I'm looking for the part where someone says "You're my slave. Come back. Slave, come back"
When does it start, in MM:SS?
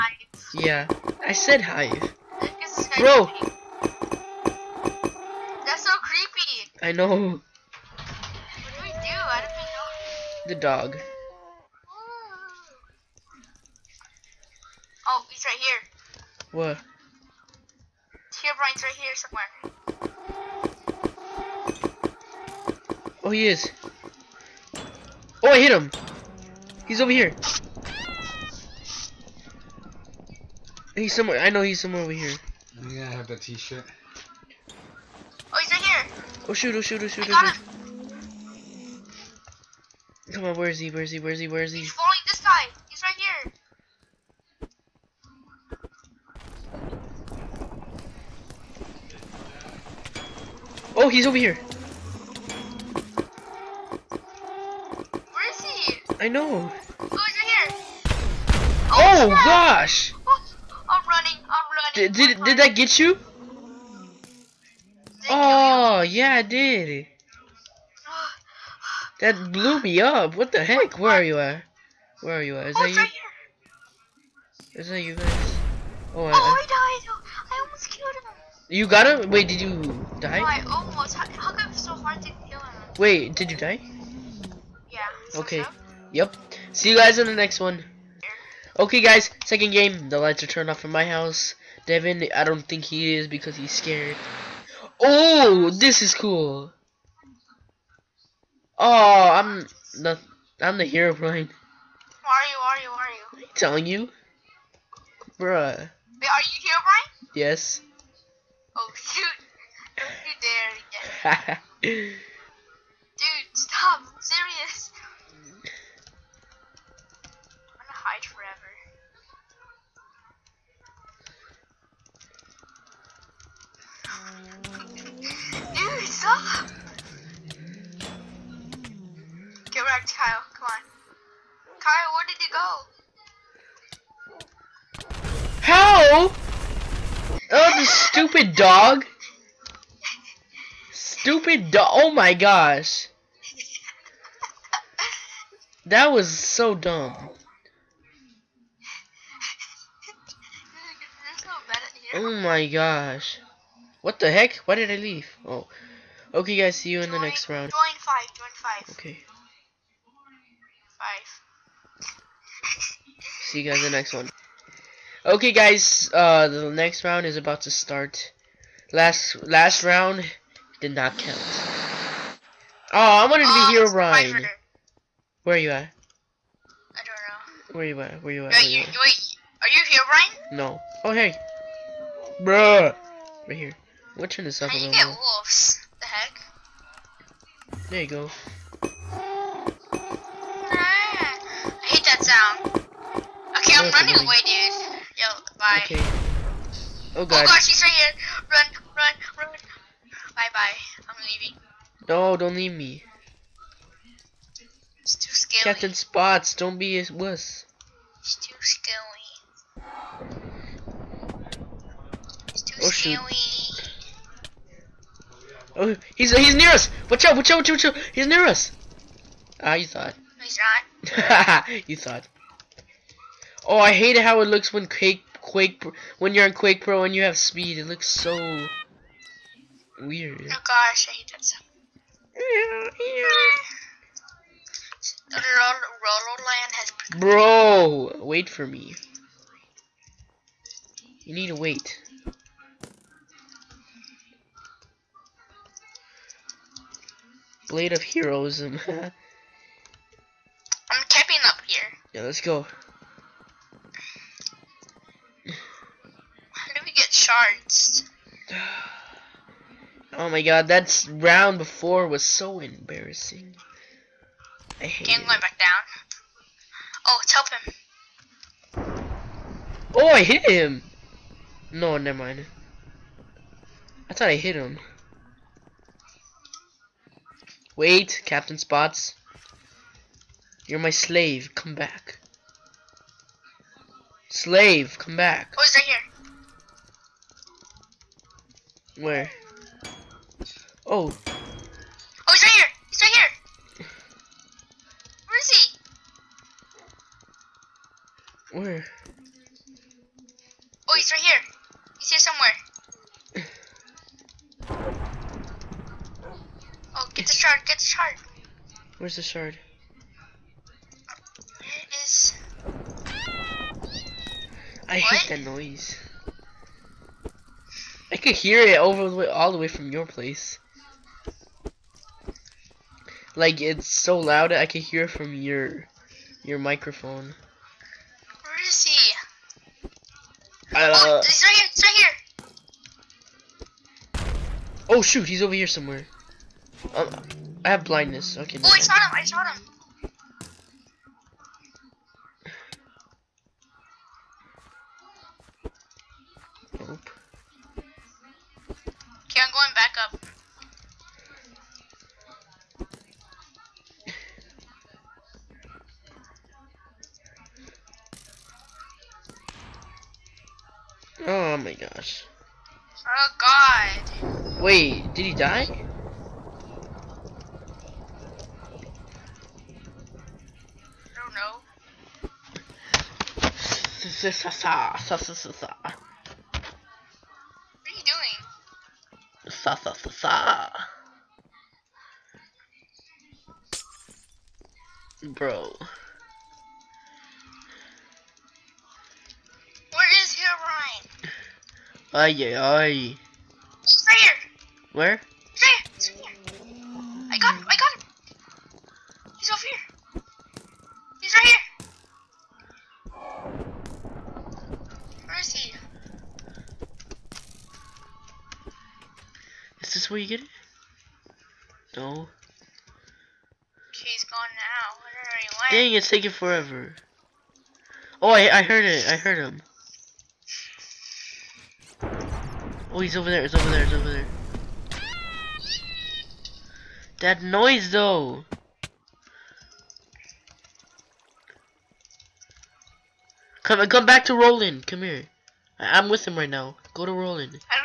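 04:40.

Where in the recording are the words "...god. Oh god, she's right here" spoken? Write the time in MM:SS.
03:17.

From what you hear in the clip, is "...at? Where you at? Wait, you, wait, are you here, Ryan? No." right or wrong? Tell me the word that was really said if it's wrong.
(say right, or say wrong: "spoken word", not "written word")
right.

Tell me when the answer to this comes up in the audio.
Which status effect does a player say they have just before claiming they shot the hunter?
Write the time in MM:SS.
05:37.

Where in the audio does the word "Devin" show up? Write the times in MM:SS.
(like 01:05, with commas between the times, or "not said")
01:31.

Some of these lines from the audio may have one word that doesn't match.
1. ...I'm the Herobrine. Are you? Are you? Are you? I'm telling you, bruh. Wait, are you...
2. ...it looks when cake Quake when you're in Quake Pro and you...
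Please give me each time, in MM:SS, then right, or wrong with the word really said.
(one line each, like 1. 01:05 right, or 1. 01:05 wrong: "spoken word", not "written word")
1. 01:40 right
2. 03:44 right.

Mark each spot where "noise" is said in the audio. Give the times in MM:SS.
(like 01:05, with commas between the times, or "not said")
05:15, 07:07.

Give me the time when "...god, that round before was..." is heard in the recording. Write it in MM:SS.
04:20.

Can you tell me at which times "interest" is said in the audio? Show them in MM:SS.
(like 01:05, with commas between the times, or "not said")
not said.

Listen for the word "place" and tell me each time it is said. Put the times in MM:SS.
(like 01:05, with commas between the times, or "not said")
05:20.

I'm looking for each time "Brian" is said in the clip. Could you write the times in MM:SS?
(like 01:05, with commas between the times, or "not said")
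00:19, 01:46.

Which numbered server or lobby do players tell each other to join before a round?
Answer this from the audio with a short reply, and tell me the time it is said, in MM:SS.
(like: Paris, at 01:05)
5, at 02:37.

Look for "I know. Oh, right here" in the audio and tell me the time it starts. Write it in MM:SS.
00:56.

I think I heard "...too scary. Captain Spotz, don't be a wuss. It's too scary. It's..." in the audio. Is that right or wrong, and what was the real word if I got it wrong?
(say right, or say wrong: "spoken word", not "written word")
right.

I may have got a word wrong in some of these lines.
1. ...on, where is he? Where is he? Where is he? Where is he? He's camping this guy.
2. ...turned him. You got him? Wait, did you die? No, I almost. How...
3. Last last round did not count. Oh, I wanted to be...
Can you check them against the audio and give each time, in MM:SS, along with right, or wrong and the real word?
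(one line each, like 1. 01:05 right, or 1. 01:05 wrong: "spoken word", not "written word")
1. 00:40 wrong: "following", not "camping"
2. 01:17 wrong: "killed", not "turned"
3. 02:48 right.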